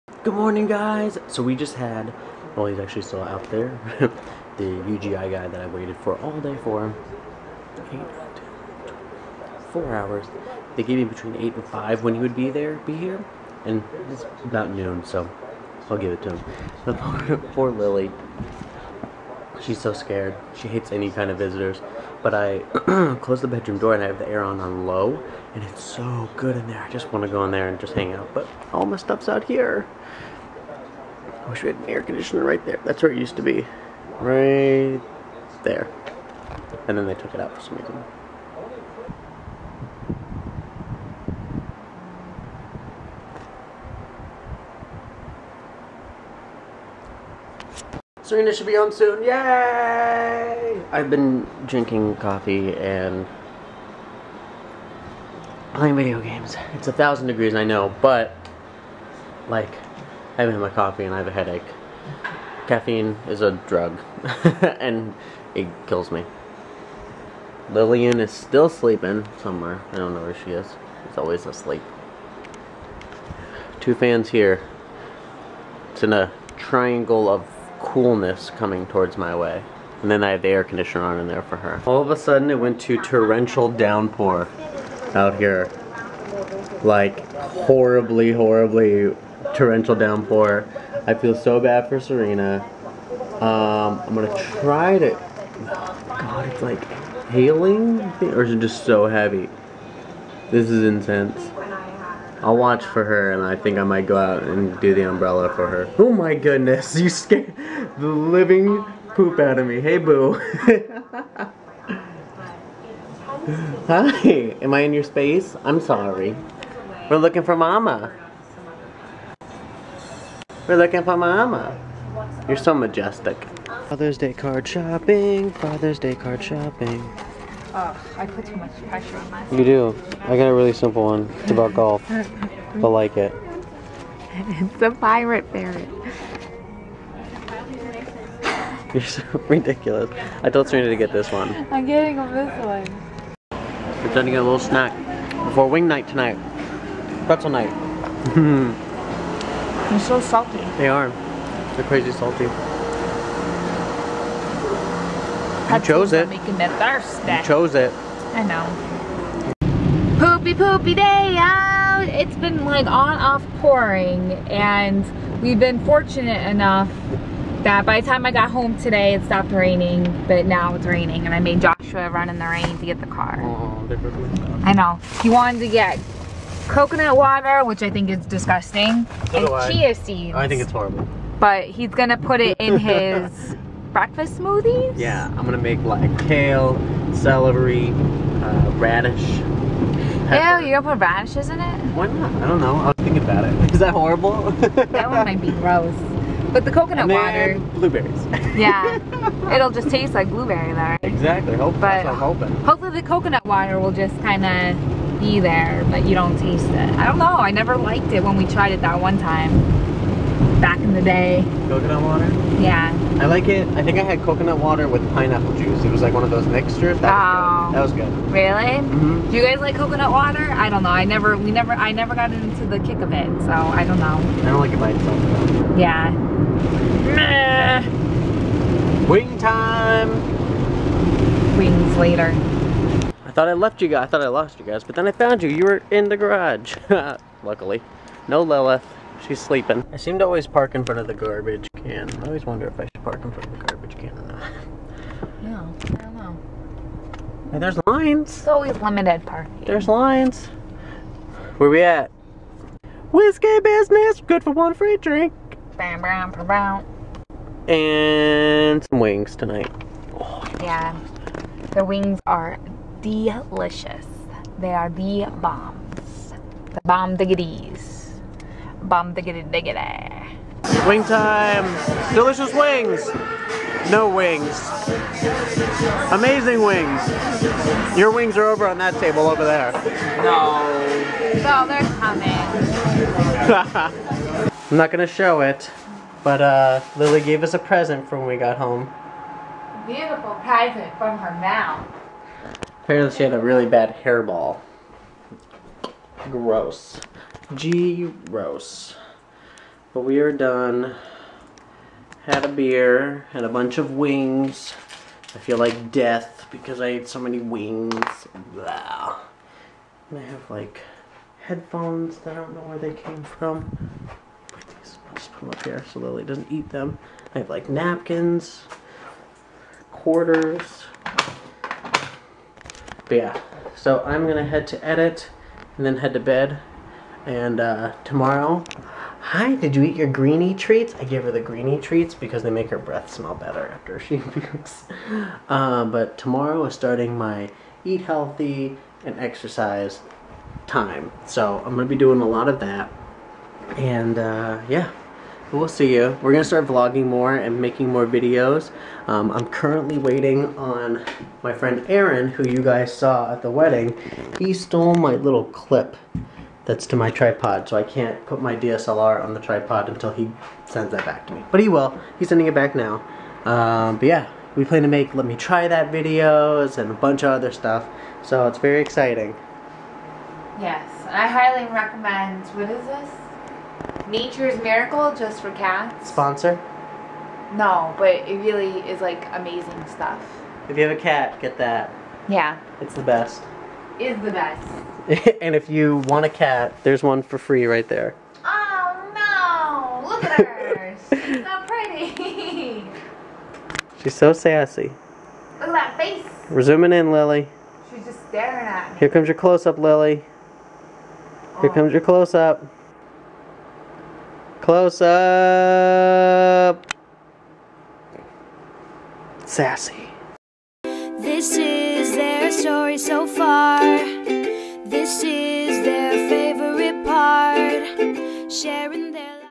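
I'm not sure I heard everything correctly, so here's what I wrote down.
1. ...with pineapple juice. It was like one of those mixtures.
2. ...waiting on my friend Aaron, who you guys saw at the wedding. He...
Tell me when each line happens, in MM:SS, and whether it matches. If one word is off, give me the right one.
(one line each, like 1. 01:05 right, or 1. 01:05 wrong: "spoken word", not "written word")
1. 03:34 right
2. 05:49 right.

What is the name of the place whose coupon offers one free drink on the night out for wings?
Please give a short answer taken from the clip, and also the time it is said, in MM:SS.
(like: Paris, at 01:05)
Whiskey Business, at 04:13.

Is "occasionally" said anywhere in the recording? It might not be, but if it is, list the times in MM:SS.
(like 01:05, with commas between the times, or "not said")
not said.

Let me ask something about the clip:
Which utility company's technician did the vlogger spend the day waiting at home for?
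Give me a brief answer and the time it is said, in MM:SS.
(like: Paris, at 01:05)
UGI, at 00:04.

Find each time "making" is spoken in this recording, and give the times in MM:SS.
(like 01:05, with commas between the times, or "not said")
02:36, 05:47.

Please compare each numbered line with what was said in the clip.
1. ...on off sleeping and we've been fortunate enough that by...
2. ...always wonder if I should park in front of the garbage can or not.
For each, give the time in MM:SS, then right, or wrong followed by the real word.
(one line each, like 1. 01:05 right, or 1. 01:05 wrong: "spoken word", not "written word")
1. 02:42 wrong: "pouring", not "sleeping"
2. 04:02 right.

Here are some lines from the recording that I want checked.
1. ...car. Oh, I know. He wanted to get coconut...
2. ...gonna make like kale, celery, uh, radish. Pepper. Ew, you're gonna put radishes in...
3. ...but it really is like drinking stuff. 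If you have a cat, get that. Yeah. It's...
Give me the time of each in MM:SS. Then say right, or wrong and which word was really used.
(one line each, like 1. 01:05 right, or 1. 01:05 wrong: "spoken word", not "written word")
1. 02:53 right
2. 03:05 right
3. 06:17 wrong: "amazing", not "drinking".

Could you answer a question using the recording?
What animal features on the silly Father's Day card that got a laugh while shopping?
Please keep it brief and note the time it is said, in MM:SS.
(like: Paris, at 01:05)
Pirate ferret, at 02:14.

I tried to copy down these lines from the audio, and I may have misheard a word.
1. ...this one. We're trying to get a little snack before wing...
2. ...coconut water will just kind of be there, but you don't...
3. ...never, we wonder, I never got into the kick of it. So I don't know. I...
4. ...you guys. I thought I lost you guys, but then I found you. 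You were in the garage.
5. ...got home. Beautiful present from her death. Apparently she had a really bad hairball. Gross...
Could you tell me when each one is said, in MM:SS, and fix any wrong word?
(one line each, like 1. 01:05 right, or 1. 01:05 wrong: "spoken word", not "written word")
1. 02:22 right
2. 03:23 right
3. 03:41 wrong: "never", not "wonder"
4. 03:53 right
5. 04:48 wrong: "mouth", not "death".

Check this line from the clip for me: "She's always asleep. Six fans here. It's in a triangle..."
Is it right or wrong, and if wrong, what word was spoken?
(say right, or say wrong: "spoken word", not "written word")
wrong: "Two", not "Six".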